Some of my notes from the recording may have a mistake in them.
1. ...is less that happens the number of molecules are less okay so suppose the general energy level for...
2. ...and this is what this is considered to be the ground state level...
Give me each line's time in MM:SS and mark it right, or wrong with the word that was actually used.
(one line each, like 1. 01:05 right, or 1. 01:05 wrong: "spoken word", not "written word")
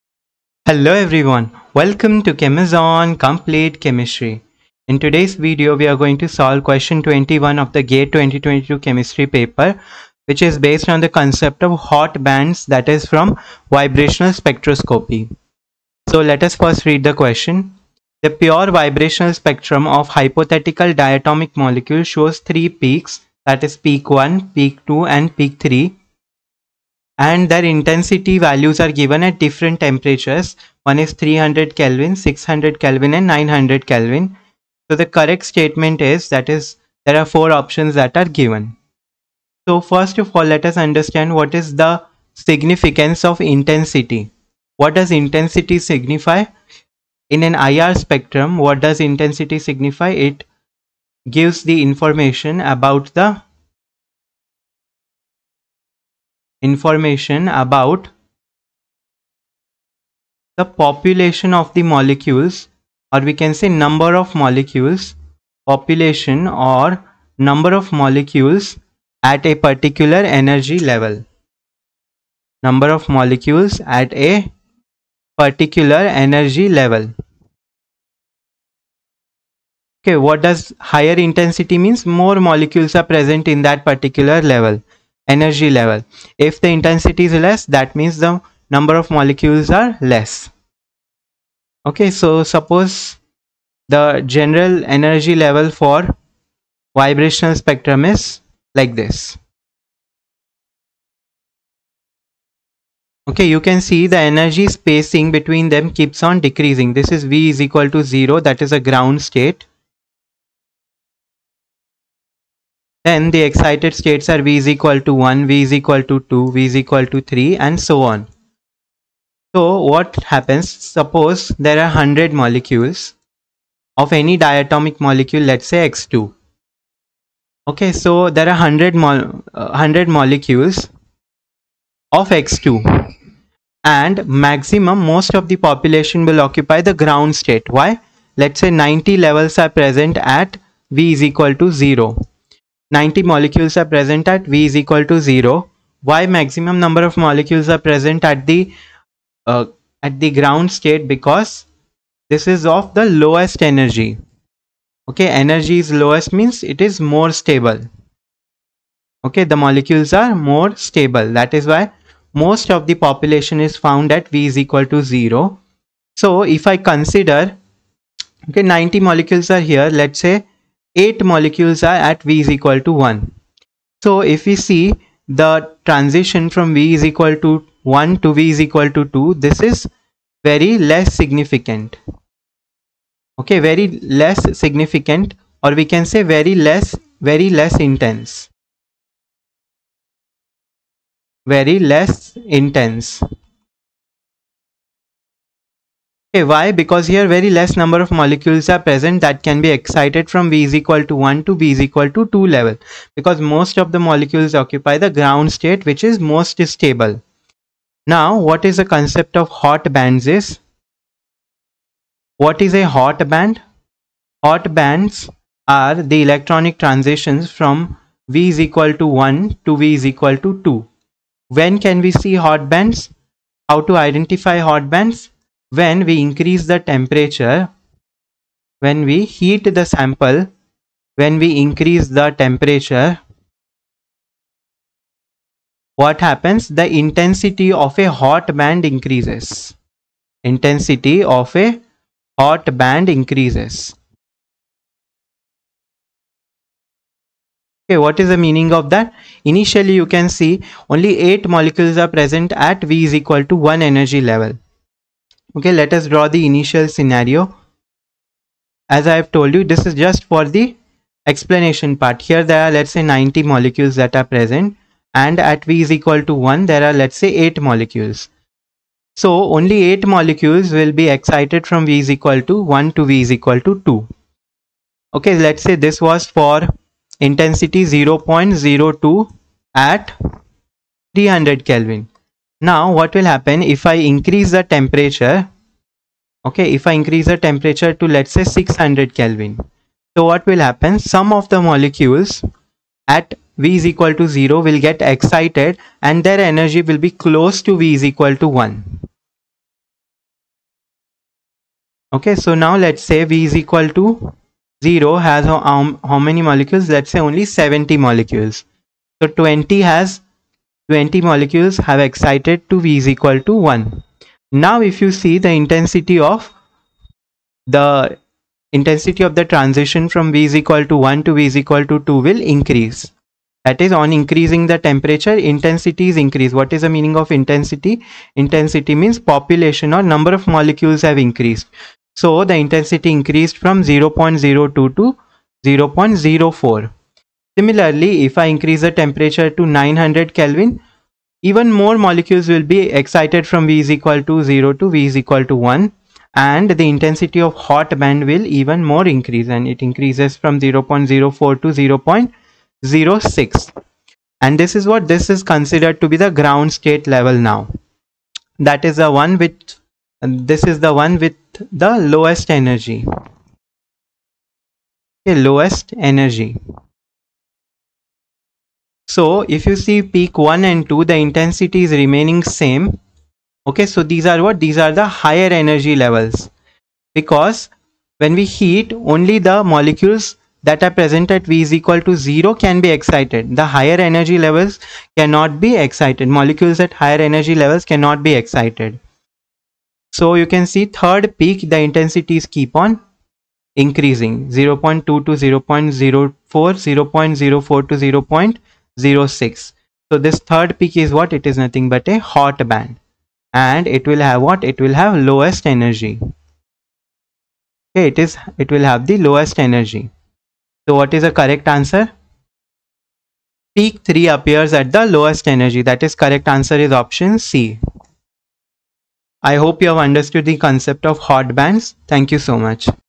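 1. 01:27 wrong: "means", not "happens"
2. 05:54 right.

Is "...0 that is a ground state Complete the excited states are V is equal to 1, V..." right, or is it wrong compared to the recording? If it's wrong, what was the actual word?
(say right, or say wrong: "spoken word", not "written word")
wrong: "Then", not "Complete".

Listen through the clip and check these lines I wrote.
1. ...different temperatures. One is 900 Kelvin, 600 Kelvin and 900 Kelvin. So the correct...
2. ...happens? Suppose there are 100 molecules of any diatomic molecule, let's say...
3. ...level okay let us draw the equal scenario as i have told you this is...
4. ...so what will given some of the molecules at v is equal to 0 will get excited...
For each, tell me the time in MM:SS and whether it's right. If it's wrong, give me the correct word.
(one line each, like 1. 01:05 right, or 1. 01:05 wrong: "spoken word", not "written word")
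1. 00:29 wrong: "300", not "900"
2. 02:00 right
3. 04:14 wrong: "initial", not "equal"
4. 04:50 wrong: "happen", not "given".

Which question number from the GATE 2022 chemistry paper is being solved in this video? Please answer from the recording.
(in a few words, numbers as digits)
21.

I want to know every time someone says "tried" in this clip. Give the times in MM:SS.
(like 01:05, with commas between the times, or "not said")
not said.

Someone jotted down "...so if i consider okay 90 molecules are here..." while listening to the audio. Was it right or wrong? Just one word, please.
right.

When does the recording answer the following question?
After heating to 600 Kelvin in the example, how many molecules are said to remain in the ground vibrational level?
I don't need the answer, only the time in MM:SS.
05:07.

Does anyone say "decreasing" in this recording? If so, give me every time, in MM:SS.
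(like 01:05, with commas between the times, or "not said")
01:46.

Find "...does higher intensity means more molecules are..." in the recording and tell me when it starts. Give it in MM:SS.
01:20.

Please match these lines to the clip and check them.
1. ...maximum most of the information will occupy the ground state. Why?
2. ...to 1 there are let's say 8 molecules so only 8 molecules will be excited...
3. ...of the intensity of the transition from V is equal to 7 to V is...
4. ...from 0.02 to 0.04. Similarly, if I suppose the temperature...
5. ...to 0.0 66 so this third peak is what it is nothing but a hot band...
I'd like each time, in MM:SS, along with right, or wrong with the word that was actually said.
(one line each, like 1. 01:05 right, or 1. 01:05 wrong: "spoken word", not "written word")
1. 02:14 wrong: "population", not "information"
2. 04:26 right
3. 05:16 wrong: "1", not "7"
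4. 05:33 wrong: "increase", not "suppose"
5. 06:37 wrong: "06", not "66".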